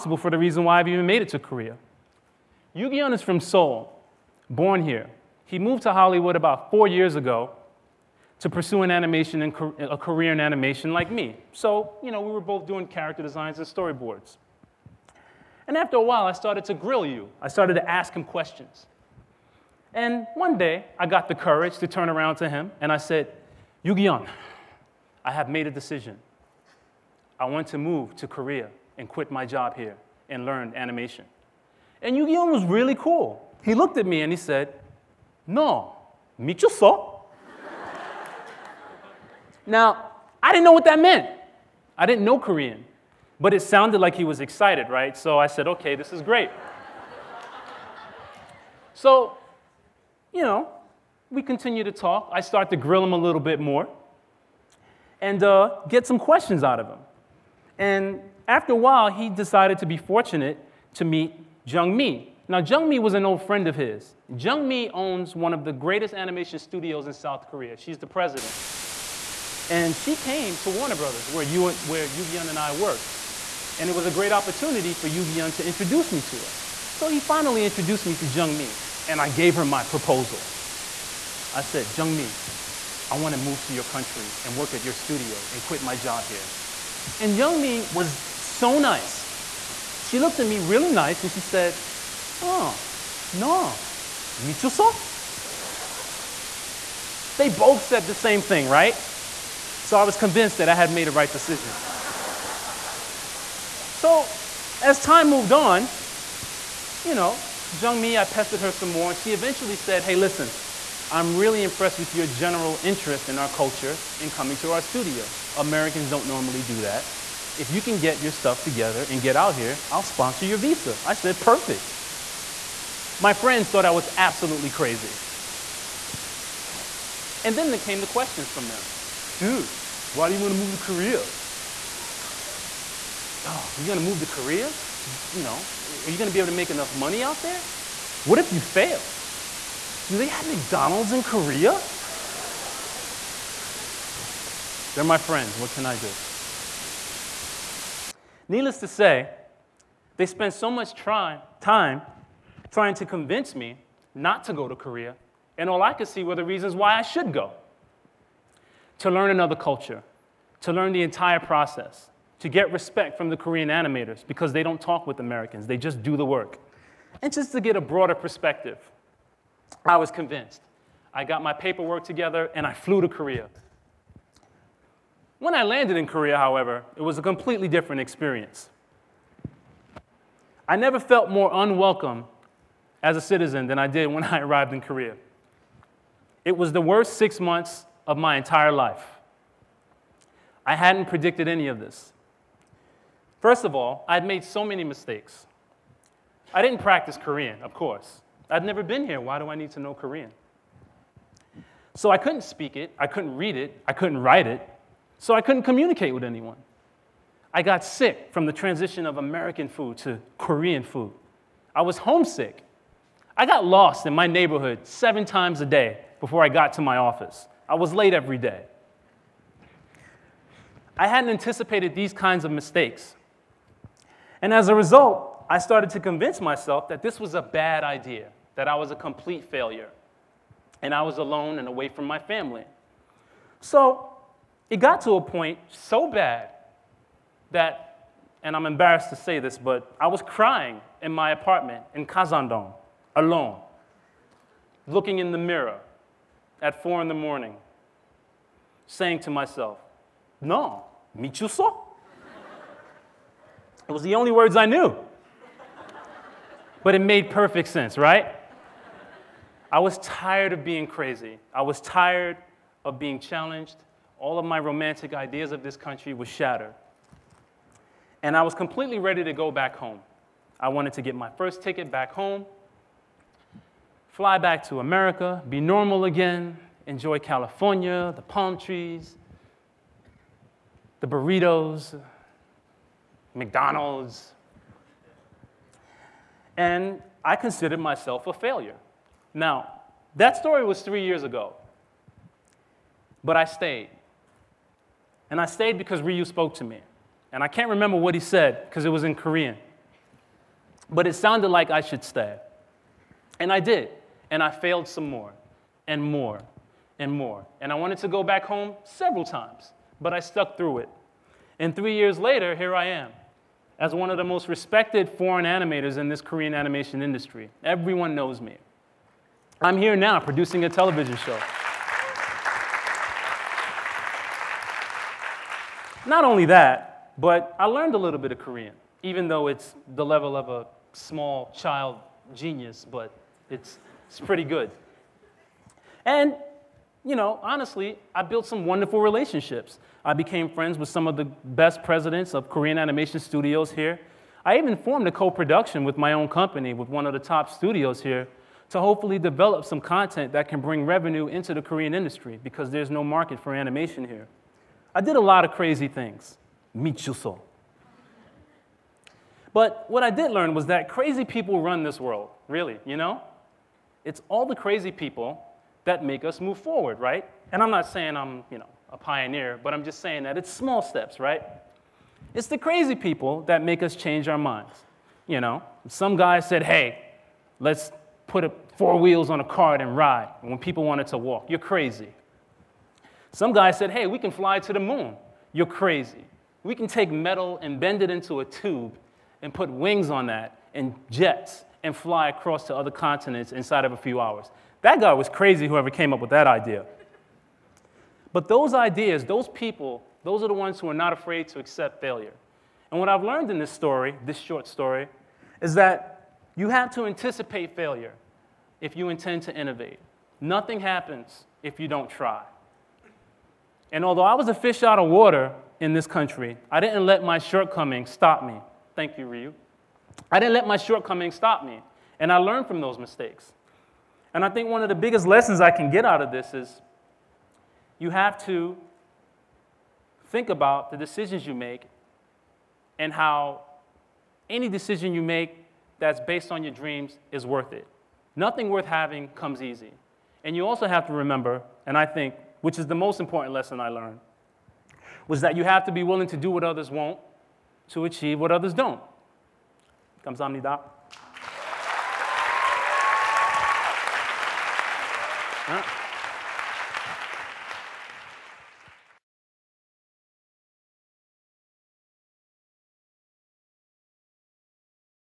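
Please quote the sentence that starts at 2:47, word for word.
And just to get a broader perspective, I was convinced.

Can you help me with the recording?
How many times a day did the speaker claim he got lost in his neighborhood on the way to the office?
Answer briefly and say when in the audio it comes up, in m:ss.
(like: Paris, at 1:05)
7, at 3:34.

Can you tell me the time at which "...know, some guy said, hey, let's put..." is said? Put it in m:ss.
6:15.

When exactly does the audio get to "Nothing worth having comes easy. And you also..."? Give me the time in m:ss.
7:18.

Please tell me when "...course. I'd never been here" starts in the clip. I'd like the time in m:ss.
3:17.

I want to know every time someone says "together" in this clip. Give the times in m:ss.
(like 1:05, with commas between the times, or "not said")
1:58, 2:52.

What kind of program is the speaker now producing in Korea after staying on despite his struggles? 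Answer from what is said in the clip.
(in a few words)
television show.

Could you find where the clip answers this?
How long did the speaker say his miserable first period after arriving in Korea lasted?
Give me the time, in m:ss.
3:07.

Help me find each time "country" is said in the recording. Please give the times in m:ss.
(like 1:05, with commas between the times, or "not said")
1:23, 4:25, 6:56.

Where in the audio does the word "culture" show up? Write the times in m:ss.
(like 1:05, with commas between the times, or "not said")
1:53, 2:39.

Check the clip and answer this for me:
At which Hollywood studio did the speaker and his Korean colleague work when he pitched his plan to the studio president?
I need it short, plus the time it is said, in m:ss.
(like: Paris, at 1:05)
Warner Brothers, at 1:10.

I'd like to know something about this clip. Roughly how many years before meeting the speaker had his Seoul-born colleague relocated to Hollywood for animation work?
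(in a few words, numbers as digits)
4.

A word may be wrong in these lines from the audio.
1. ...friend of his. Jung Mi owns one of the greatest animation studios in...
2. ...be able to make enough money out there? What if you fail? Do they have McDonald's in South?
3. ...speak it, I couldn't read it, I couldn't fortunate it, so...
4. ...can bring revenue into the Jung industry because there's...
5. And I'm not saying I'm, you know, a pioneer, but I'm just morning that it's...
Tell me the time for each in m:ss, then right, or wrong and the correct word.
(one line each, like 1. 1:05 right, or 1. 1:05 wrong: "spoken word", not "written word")
1. 1:03 right
2. 2:16 wrong: "Korea", not "South"
3. 3:22 wrong: "write", not "fortunate"
4. 5:50 wrong: "Korean", not "Jung"
5. 6:07 wrong: "saying", not "morning".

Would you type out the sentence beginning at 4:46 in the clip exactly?
And I considered myself a failure.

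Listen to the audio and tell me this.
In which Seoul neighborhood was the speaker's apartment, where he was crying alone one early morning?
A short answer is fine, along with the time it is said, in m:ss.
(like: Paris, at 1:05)
Kazandong, at 4:02.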